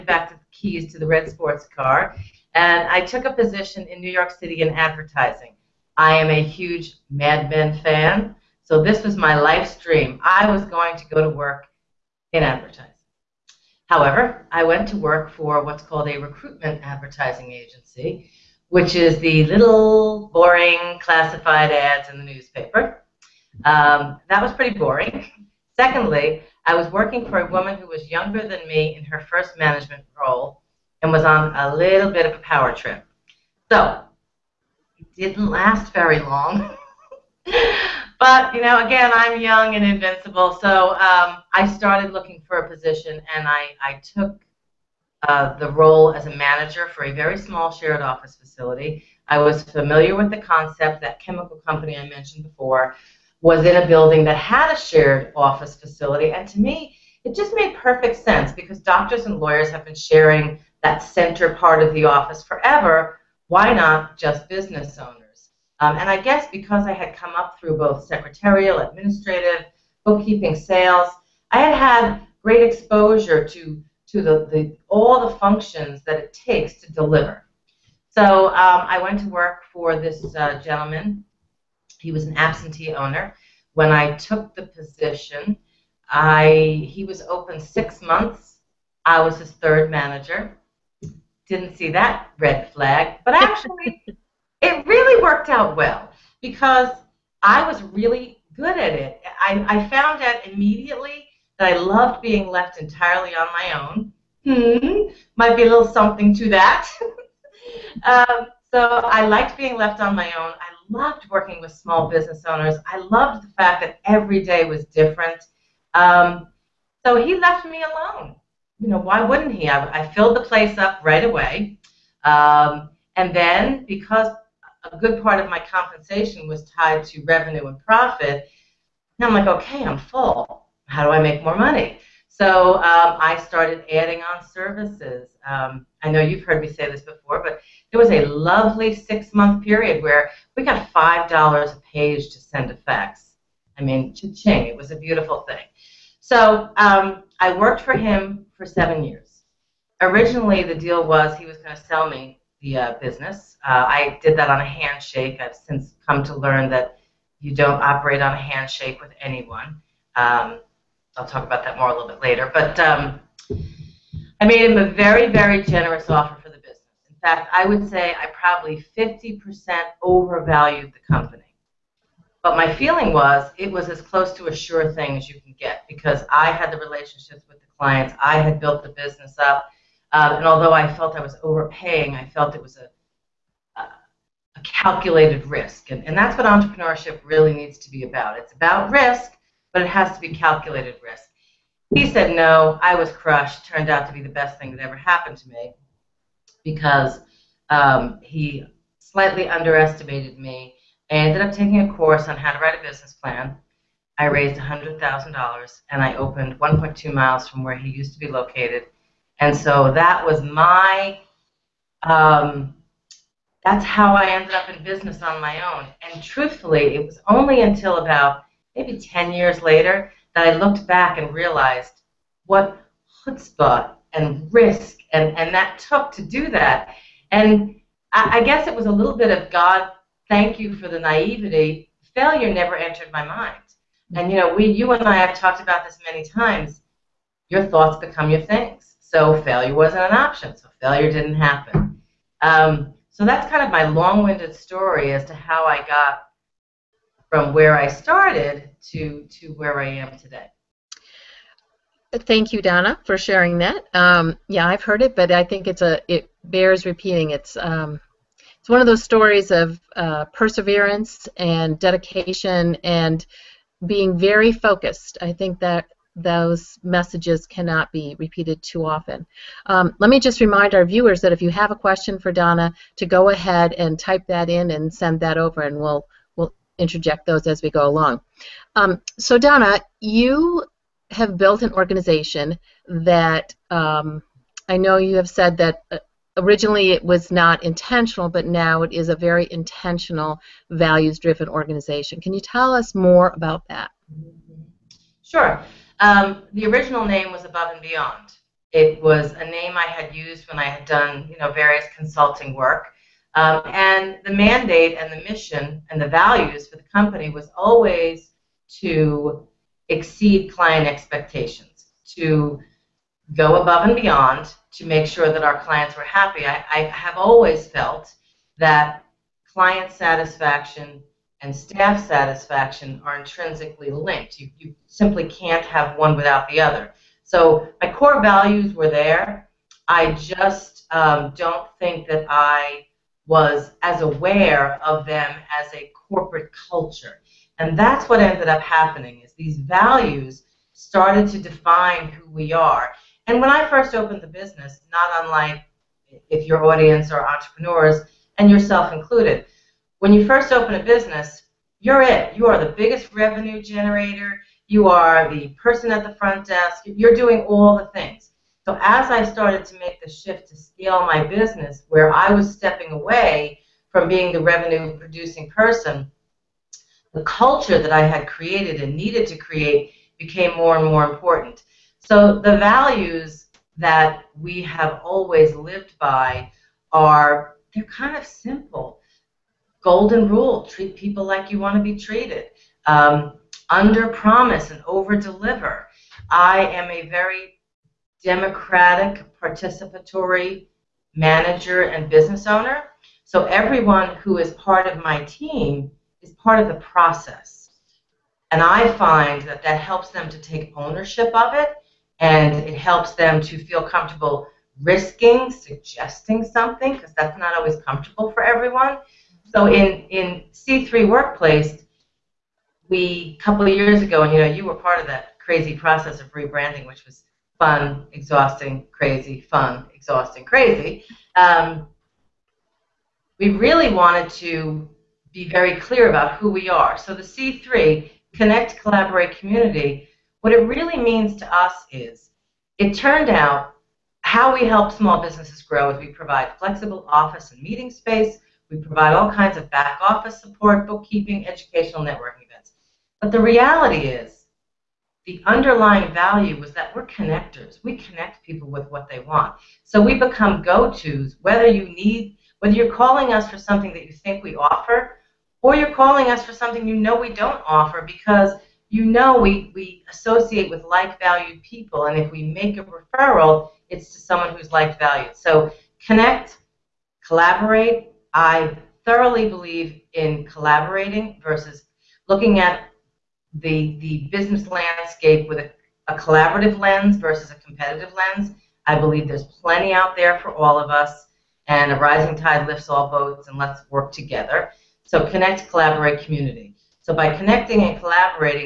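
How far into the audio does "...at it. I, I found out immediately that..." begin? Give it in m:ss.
1:38.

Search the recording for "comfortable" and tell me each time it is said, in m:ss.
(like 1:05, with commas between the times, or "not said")
6:43, 6:47.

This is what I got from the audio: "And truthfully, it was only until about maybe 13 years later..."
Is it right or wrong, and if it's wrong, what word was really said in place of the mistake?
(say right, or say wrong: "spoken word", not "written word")
wrong: "10", not "13".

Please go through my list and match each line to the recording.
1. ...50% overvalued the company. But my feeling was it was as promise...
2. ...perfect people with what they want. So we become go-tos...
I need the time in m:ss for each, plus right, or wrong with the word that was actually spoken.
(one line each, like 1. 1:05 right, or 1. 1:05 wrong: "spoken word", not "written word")
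1. 2:48 wrong: "close", not "promise"
2. 7:27 wrong: "connect", not "perfect".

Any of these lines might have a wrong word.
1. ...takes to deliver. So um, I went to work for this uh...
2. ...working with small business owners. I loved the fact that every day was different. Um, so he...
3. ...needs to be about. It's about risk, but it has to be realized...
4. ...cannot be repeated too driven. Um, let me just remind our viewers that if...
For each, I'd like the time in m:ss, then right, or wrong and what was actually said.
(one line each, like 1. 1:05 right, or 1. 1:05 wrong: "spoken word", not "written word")
1. 1:16 right
2. 1:51 right
3. 3:07 wrong: "calculated", not "realized"
4. 4:27 wrong: "often", not "driven".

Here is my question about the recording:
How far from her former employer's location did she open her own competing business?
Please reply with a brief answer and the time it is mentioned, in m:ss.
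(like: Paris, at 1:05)
1.2 miles, at 3:26.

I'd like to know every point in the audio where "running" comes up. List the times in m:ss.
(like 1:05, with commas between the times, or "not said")
not said.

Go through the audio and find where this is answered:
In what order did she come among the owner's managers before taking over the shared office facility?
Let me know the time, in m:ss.
1:29.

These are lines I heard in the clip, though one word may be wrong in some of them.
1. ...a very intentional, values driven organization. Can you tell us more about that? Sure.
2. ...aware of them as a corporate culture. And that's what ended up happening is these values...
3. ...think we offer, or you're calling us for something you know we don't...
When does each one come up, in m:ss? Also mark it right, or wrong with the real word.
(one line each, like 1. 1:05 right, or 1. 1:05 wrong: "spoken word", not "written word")
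1. 4:49 right
2. 5:34 right
3. 7:34 right.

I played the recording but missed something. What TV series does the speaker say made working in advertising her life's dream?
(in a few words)
Mad Men.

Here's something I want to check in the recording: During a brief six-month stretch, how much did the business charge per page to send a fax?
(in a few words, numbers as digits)
$5.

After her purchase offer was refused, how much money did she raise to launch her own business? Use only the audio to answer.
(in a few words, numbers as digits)
$100,000.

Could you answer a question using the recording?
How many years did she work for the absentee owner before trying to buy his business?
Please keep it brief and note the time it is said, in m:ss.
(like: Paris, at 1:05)
7, at 2:28.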